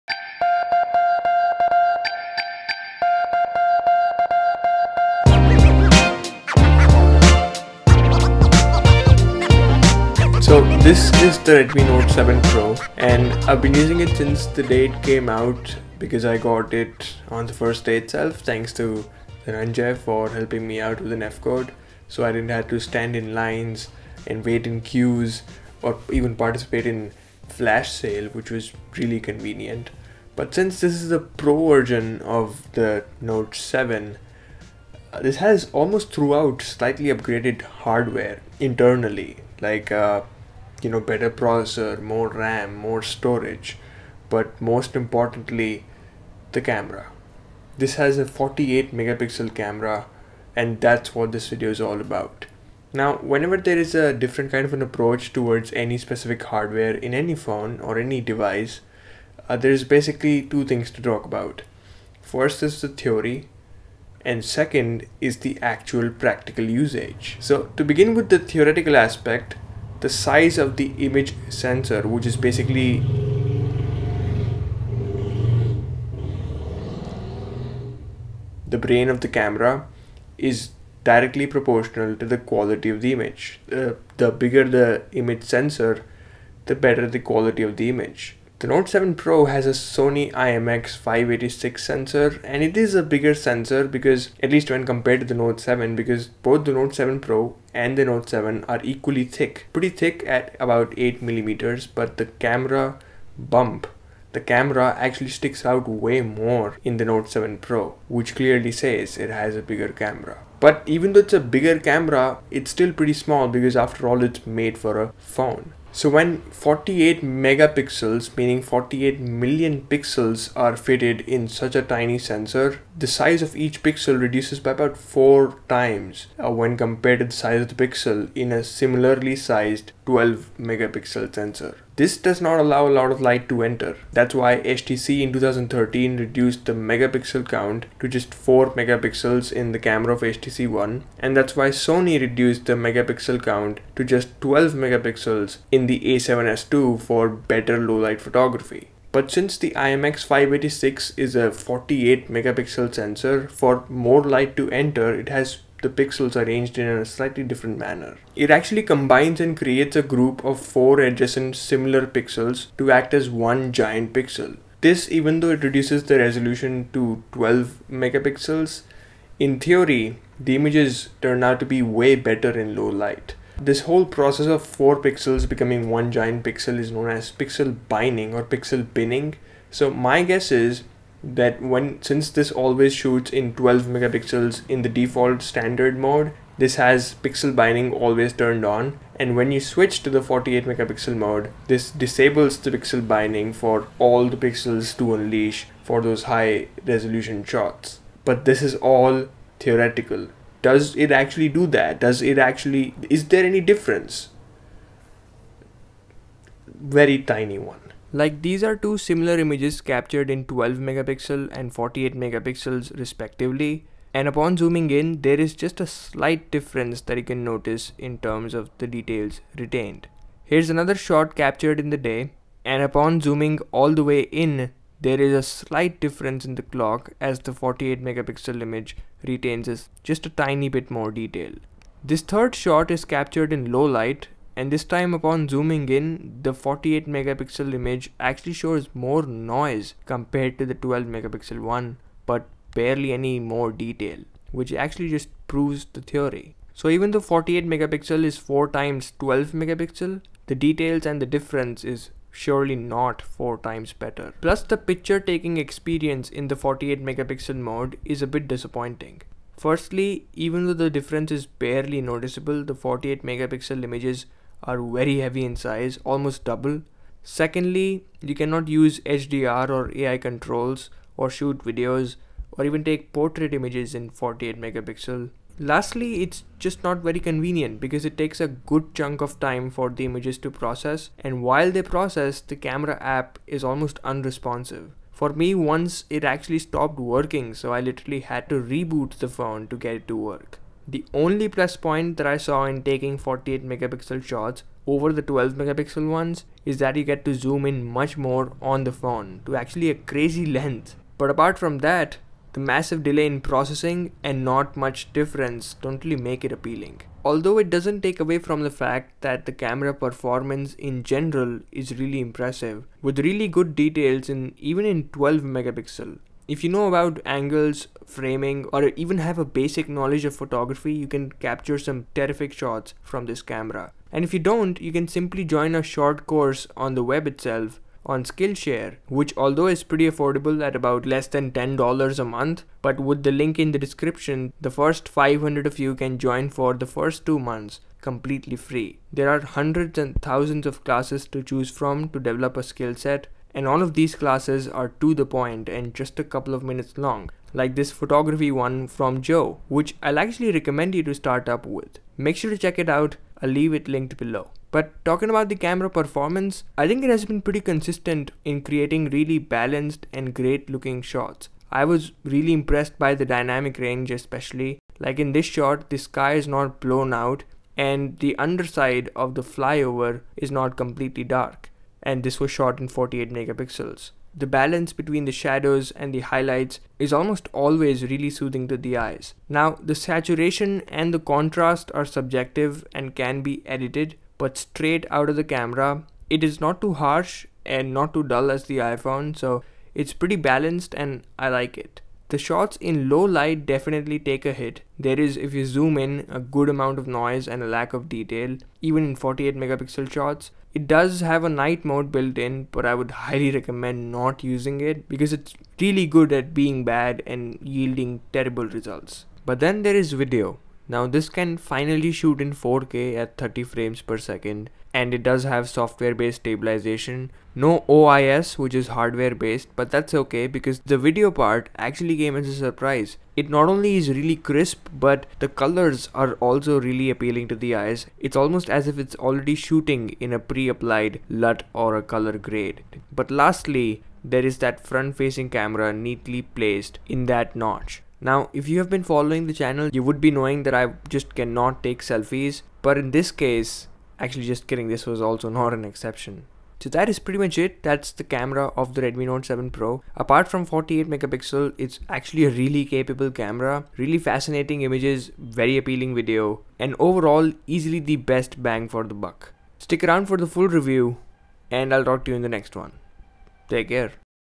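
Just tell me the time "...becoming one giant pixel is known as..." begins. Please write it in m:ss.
2:55.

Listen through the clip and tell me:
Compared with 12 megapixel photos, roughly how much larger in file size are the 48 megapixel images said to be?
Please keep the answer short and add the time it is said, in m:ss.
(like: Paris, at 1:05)
almost double, at 4:26.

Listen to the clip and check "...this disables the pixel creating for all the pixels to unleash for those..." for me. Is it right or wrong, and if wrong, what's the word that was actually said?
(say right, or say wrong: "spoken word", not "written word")
wrong: "binding", not "creating".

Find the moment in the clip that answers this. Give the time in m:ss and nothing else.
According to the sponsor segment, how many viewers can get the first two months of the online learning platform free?
5:35.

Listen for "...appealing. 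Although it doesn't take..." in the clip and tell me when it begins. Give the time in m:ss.
5:06.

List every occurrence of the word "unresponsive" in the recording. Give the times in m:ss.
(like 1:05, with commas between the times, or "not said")
4:44.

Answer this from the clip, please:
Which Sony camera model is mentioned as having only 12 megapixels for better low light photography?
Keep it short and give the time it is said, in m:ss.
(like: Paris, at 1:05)
a7S II, at 2:26.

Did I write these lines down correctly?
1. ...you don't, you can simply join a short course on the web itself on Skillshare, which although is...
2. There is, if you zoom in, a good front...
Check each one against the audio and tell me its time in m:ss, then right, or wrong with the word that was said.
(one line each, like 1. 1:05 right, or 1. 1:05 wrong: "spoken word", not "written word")
1. 5:24 right
2. 6:35 wrong: "amount", not "front".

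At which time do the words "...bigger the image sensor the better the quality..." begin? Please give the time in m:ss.
1:24.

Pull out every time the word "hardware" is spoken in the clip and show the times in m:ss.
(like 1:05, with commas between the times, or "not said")
0:37, 0:56, 6:58.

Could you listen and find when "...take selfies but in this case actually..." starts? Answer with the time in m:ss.
7:21.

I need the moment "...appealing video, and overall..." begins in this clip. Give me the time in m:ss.
7:35.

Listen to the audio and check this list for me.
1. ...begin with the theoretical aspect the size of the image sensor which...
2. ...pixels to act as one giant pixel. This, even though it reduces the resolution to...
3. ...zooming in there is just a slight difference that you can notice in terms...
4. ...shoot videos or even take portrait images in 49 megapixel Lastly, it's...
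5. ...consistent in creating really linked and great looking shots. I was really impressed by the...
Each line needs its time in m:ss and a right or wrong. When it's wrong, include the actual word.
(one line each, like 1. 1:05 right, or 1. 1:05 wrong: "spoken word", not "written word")
1. 1:07 right
2. 2:42 right
3. 3:34 right
4. 4:31 wrong: "48", not "49"
5. 5:57 wrong: "balanced", not "linked".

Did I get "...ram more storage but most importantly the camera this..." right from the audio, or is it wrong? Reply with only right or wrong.
right.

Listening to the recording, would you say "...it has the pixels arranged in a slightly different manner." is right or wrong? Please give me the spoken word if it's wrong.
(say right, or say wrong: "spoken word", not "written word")
right.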